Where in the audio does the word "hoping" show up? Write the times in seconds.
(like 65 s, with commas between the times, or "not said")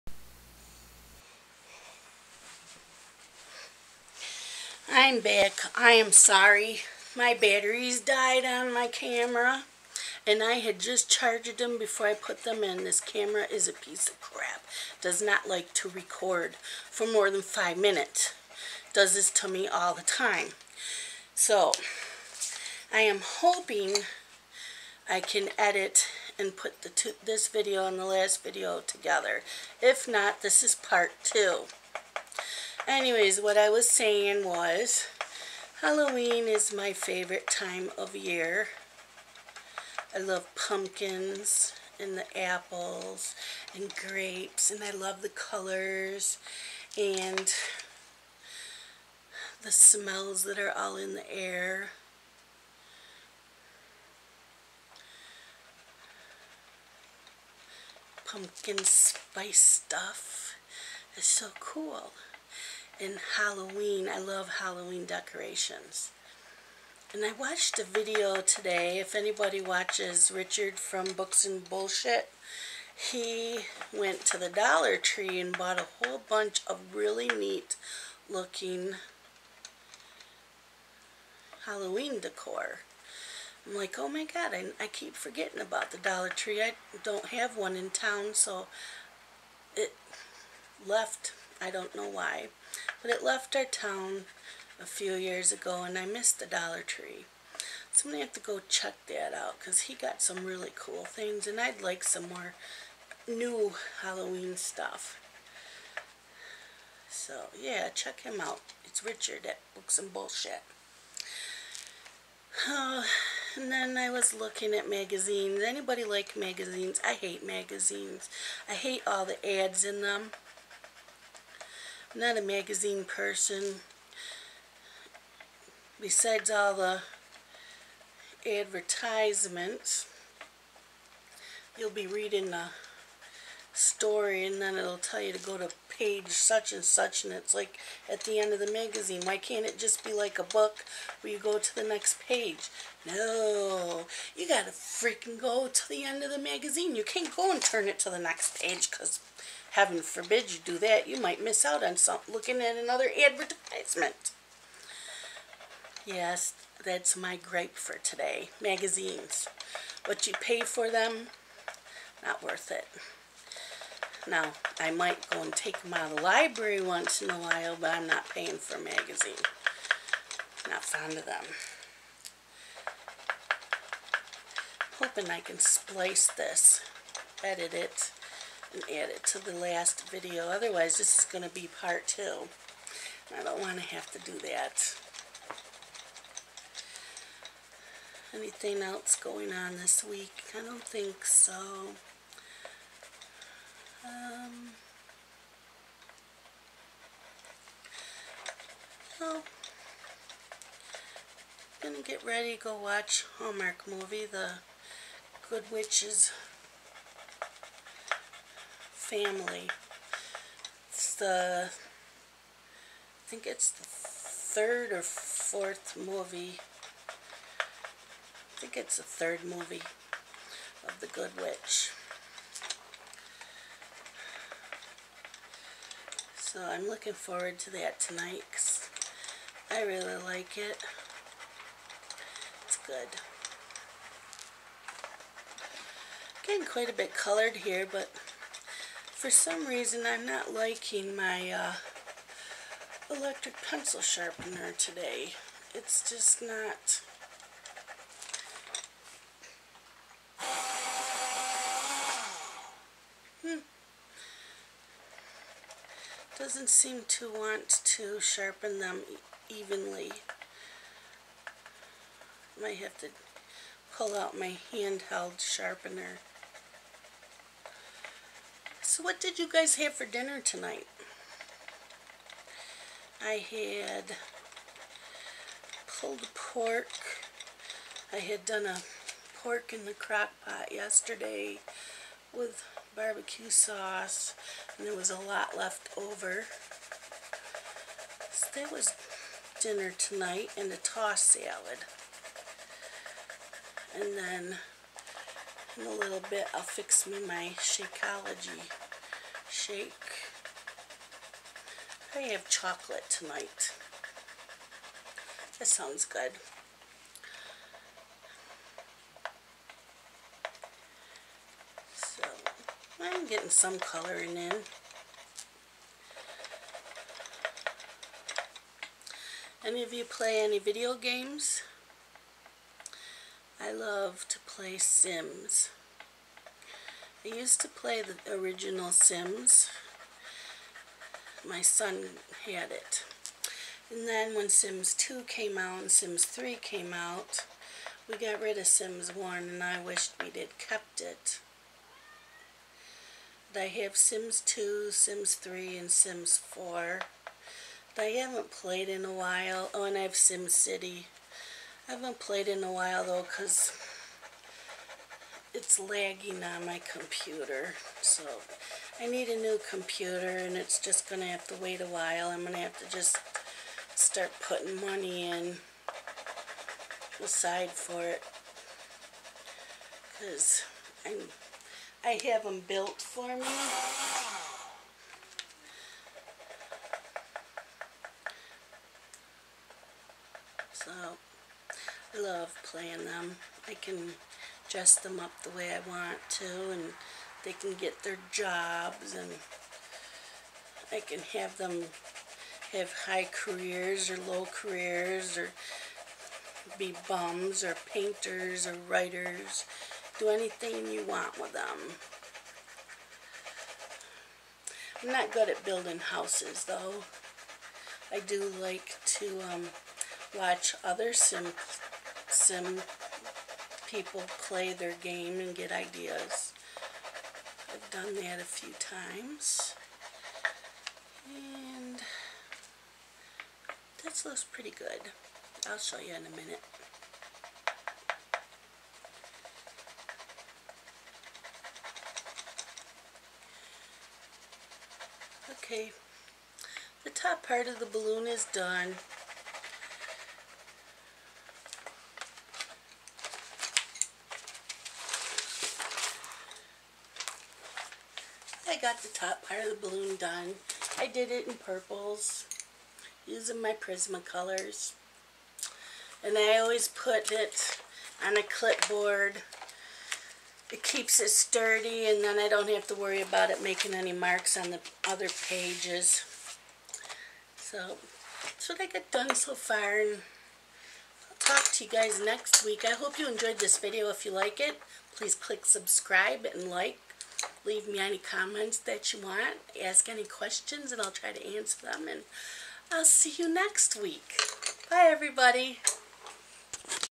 23 s, 174 s.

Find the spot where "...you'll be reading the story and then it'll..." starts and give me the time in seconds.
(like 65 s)
131 s.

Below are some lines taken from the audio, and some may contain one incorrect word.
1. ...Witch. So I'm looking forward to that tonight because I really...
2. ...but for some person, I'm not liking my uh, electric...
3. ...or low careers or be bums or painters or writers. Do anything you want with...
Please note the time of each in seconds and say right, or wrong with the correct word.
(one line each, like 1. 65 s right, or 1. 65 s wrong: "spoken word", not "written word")
1. 221 s right
2. 237 s wrong: "reason", not "person"
3. 394 s right.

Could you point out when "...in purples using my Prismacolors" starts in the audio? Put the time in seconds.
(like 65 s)
451 s.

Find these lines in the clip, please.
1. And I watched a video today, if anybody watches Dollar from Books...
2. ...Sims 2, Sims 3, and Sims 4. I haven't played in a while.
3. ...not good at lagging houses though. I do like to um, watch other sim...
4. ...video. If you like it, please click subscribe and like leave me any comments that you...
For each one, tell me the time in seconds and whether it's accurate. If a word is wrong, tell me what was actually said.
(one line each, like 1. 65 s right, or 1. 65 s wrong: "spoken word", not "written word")
1. 67 s wrong: "Richard", not "Dollar"
2. 343 s right
3. 405 s wrong: "building", not "lagging"
4. 473 s right.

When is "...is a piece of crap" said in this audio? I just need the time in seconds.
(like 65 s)
13 s.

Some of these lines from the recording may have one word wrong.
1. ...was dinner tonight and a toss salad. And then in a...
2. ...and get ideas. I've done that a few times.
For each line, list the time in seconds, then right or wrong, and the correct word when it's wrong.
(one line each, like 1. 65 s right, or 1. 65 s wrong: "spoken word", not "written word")
1. 288 s right
2. 415 s right.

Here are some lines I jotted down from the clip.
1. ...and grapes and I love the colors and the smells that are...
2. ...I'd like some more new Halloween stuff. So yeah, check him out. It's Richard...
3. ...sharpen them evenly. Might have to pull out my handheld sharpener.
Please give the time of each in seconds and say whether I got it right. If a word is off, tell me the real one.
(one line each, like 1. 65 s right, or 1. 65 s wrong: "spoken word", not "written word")
1. 43 s right
2. 101 s right
3. 258 s right.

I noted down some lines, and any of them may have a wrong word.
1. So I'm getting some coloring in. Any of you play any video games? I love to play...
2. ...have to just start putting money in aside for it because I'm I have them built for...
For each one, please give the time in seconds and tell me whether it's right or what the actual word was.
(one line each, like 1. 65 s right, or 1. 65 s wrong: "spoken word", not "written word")
1. 311 s right
2. 362 s right.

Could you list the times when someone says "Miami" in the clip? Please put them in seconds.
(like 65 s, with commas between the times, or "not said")
not said.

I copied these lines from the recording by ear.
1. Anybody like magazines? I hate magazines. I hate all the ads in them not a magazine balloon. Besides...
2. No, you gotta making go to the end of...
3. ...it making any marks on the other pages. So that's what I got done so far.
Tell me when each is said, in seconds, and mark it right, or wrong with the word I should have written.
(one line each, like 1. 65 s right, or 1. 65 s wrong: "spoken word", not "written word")
1. 115 s wrong: "person", not "balloon"
2. 143 s wrong: "freaking", not "making"
3. 463 s right.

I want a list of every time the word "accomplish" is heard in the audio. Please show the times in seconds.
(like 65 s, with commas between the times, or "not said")
not said.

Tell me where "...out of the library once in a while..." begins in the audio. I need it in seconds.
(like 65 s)
165 s.